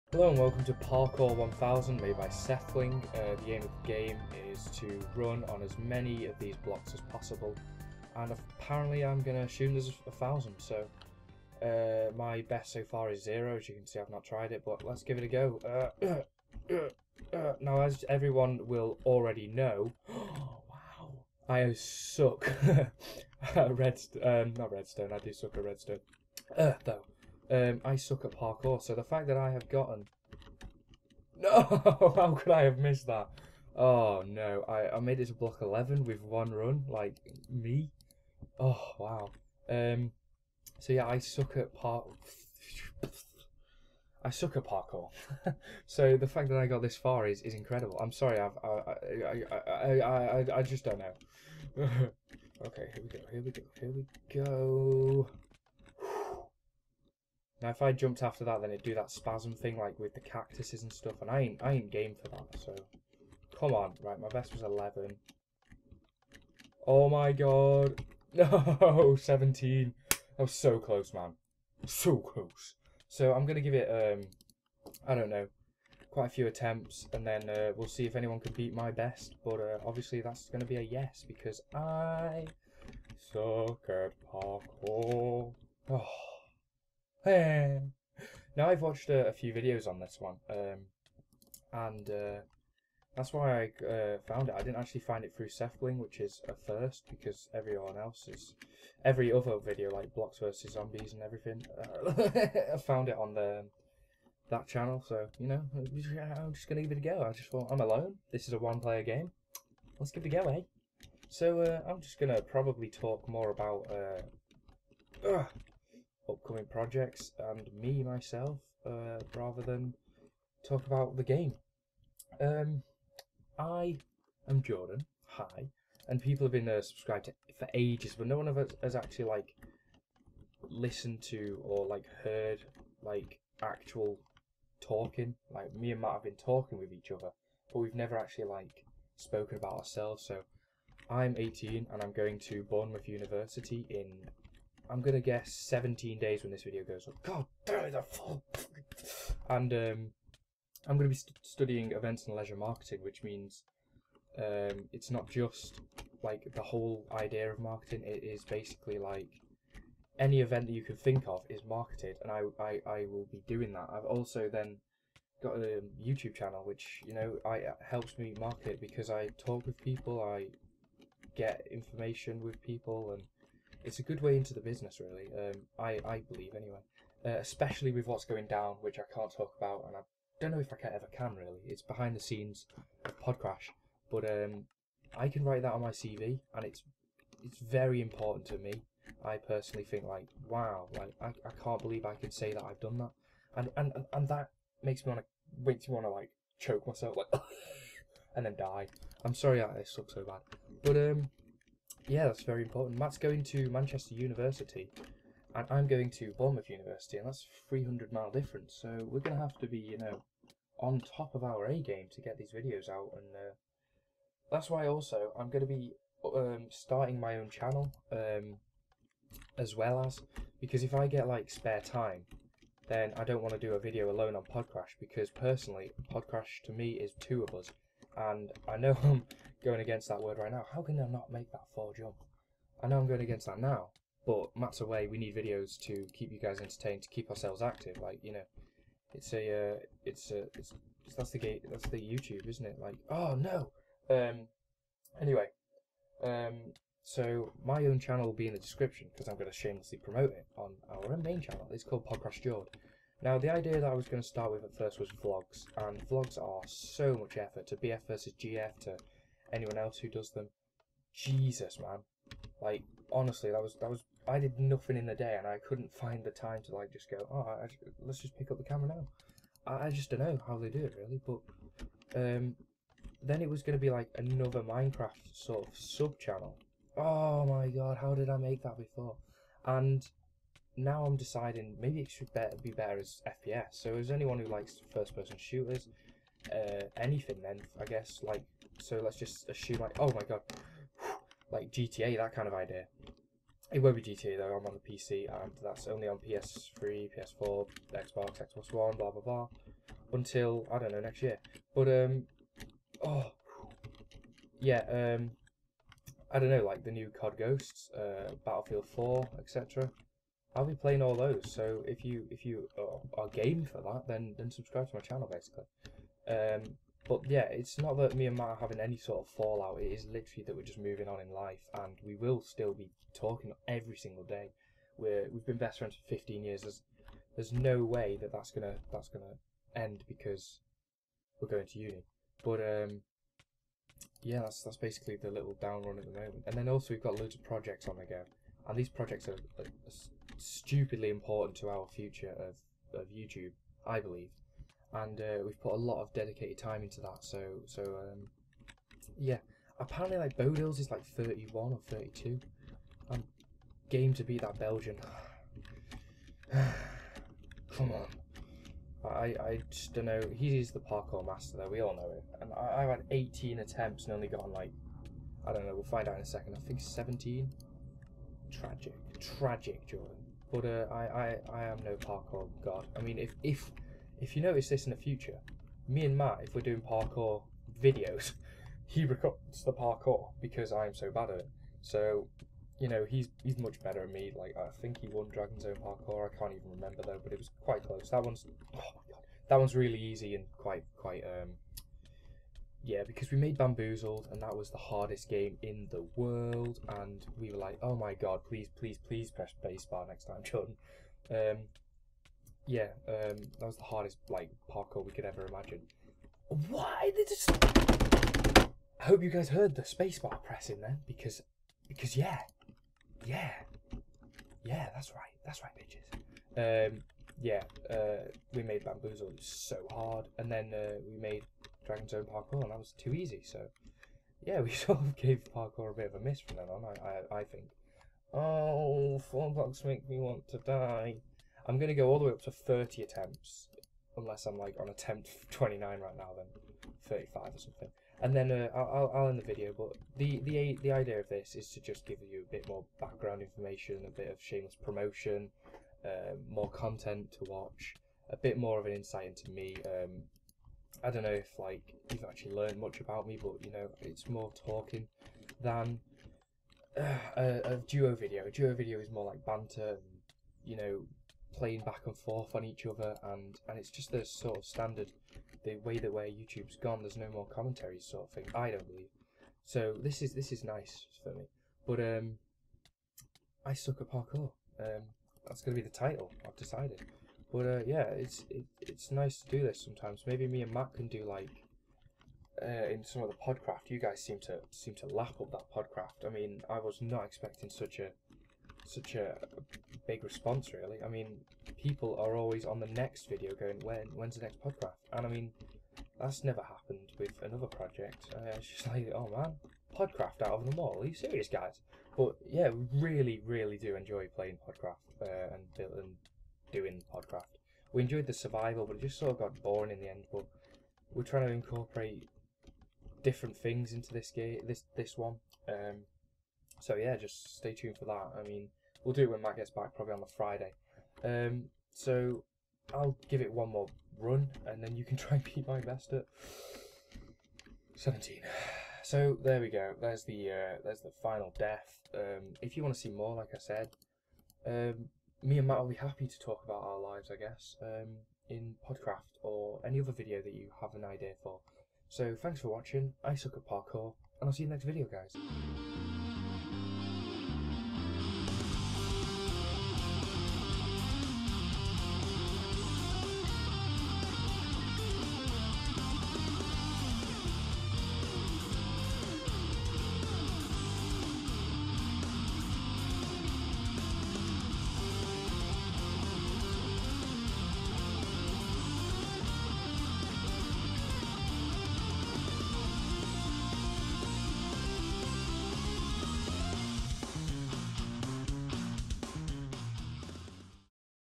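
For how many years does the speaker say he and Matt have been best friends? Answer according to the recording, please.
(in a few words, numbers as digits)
15.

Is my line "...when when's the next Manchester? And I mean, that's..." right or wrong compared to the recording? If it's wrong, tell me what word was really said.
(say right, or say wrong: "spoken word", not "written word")
wrong: "Podcraft", not "Manchester".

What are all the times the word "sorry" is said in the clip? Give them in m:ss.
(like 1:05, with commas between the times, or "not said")
0:48, 3:19.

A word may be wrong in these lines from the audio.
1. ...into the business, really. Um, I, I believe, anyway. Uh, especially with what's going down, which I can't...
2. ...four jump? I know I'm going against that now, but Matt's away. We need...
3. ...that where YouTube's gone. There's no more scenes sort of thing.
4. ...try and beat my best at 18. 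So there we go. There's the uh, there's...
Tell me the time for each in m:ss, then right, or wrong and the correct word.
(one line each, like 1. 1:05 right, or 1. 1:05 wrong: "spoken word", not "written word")
1. 2:54 right
2. 3:51 right
3. 7:45 wrong: "commentaries", not "scenes"
4. 8:45 wrong: "17", not "18".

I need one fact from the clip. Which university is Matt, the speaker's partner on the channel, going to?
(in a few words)
Manchester University.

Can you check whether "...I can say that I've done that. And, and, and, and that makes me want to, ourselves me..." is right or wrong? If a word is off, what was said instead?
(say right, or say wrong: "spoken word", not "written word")
wrong: "makes", not "ourselves".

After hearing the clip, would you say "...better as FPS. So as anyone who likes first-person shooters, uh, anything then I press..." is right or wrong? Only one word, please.
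wrong.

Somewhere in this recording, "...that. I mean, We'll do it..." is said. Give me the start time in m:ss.
8:38.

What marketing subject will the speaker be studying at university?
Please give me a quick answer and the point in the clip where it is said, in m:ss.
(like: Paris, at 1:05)
Events and leisure marketing, at 2:31.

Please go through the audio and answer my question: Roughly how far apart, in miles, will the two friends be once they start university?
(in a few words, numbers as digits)
300.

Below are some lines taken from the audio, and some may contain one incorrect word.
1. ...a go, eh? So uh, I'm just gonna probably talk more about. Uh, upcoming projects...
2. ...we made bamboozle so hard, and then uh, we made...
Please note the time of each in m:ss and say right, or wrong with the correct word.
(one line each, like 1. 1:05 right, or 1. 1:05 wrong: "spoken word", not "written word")
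1. 1:50 right
2. 6:58 right.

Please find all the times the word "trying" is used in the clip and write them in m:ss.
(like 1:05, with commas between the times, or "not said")
8:31.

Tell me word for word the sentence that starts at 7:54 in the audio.
Um, that's gonna be the title.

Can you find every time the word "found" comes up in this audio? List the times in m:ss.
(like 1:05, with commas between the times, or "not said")
1:34, 1:42.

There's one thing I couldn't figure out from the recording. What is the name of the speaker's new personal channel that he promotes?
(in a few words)
Podcrash Jord.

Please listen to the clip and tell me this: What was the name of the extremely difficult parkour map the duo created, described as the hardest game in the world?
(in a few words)
Bamboozled.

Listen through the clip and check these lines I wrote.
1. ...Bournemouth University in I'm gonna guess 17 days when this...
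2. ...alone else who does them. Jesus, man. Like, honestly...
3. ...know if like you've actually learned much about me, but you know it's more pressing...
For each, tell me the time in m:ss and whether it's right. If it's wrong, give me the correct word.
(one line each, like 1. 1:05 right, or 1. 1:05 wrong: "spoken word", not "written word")
1. 2:22 right
2. 4:19 wrong: "anyone", not "alone"
3. 7:31 wrong: "talking", not "pressing".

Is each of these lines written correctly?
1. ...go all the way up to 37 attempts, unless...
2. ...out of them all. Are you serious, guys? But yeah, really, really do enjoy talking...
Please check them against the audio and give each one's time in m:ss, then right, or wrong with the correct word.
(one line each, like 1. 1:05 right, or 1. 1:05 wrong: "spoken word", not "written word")
1. 7:11 wrong: "30", not "37"
2. 8:20 wrong: "playing", not "talking".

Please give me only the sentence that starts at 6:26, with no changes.
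I can't even remember though, but it was quite close.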